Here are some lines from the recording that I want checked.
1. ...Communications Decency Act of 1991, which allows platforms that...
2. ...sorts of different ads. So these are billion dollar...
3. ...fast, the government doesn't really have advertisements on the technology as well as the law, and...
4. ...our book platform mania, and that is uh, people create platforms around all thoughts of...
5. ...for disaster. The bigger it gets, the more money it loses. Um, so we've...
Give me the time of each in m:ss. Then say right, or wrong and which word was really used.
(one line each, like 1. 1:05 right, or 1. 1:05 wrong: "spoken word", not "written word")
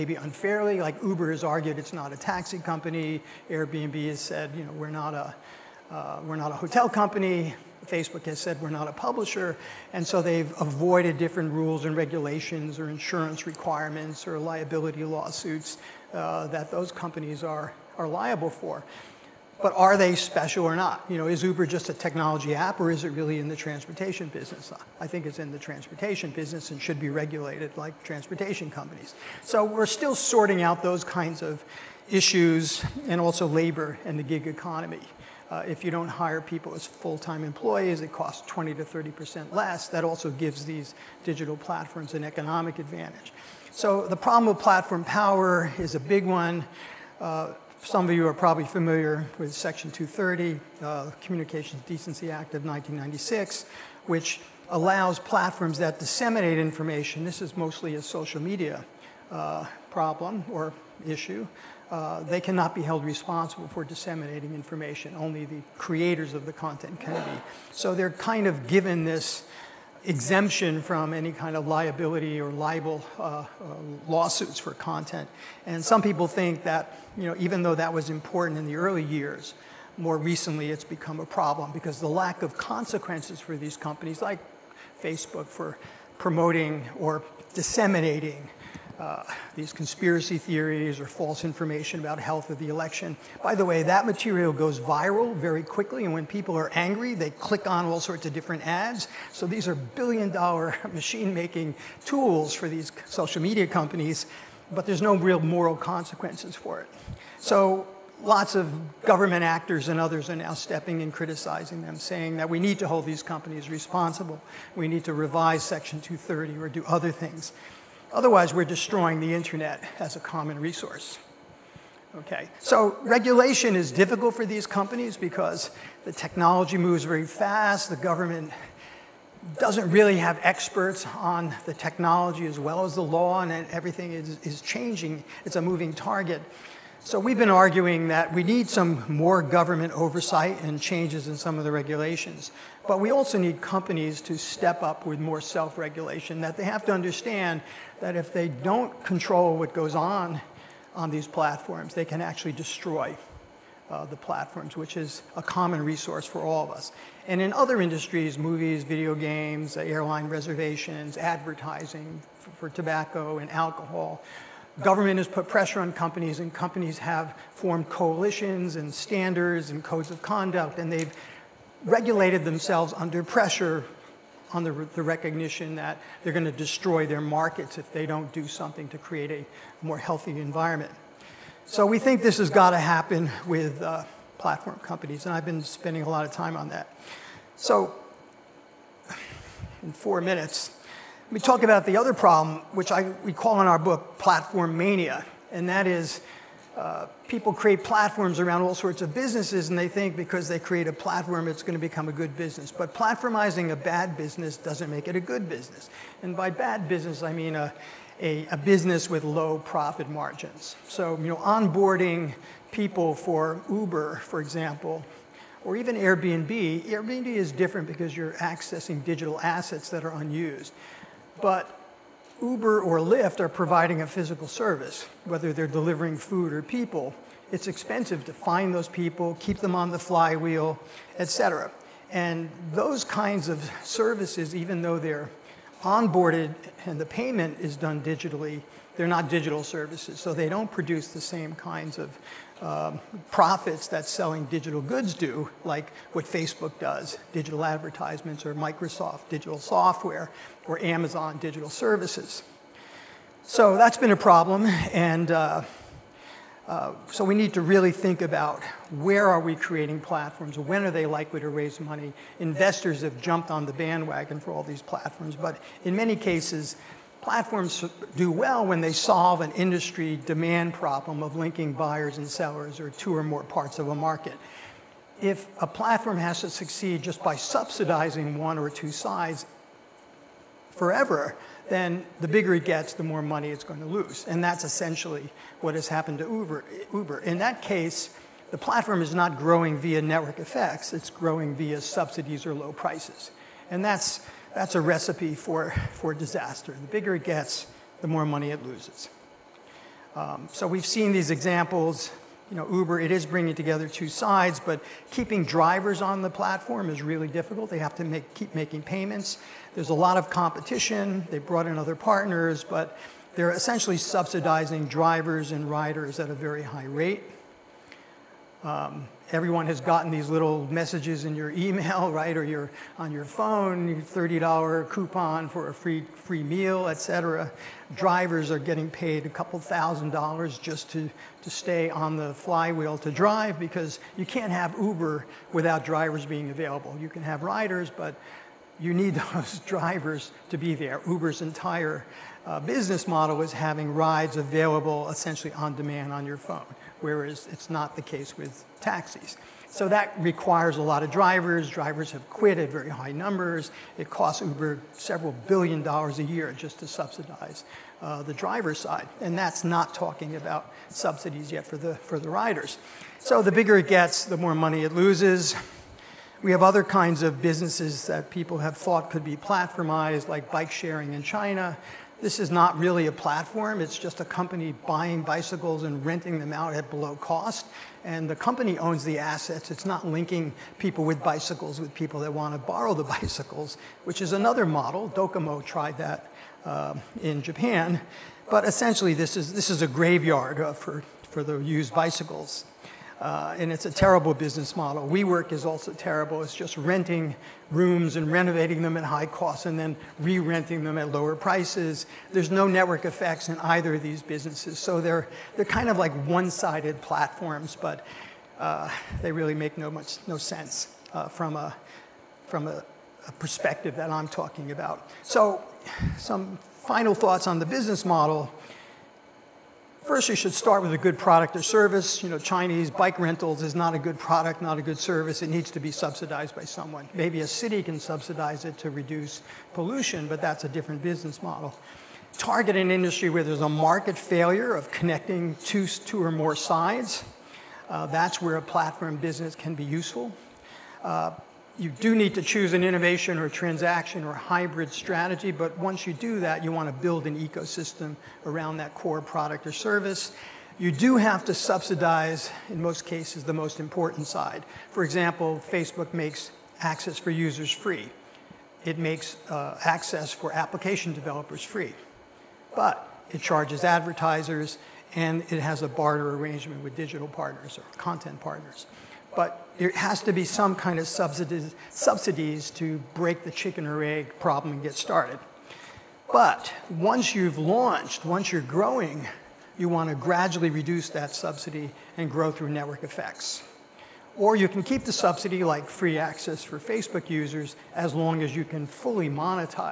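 1. 0:51 wrong: "1996", not "1991"
2. 1:37 right
3. 2:07 wrong: "experts", not "advertisements"
4. 3:13 wrong: "sorts", not "thoughts"
5. 4:55 right.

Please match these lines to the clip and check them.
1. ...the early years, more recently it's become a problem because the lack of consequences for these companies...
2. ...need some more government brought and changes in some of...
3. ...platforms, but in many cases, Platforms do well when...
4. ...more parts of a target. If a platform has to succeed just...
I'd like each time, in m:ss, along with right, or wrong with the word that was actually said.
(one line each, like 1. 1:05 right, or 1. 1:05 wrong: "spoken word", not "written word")
1. 1:18 right
2. 2:18 wrong: "oversight", not "brought"
3. 4:24 right
4. 4:33 wrong: "market", not "target".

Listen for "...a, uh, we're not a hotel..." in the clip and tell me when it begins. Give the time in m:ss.
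0:05.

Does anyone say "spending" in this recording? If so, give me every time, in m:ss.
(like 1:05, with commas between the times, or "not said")
3:05.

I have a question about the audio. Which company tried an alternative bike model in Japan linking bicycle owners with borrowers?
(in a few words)
Docomo.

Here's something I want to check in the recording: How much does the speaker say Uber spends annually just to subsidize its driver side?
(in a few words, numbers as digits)
several billion dollars.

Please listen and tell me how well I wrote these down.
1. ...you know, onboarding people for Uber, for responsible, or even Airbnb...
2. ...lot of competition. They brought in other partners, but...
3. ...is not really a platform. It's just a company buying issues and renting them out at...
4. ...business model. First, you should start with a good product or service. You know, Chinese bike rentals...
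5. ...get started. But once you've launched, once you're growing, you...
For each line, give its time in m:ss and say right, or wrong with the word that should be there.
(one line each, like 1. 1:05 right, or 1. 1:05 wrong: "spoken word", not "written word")
1. 3:31 wrong: "example", not "responsible"
2. 5:09 right
3. 6:12 wrong: "bicycles", not "issues"
4. 6:57 right
5. 7:54 right.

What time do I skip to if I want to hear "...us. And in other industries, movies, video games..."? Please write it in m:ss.
2:36.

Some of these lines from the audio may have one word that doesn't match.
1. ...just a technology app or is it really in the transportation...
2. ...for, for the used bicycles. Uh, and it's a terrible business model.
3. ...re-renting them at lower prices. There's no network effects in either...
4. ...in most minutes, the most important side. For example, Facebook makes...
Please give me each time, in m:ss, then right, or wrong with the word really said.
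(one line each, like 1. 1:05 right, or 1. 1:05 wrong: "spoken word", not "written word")
1. 0:21 right
2. 6:30 right
3. 6:40 right
4. 7:32 wrong: "cases", not "minutes".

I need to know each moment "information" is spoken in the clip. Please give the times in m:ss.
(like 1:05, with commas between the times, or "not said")
0:56, 1:04, 1:31.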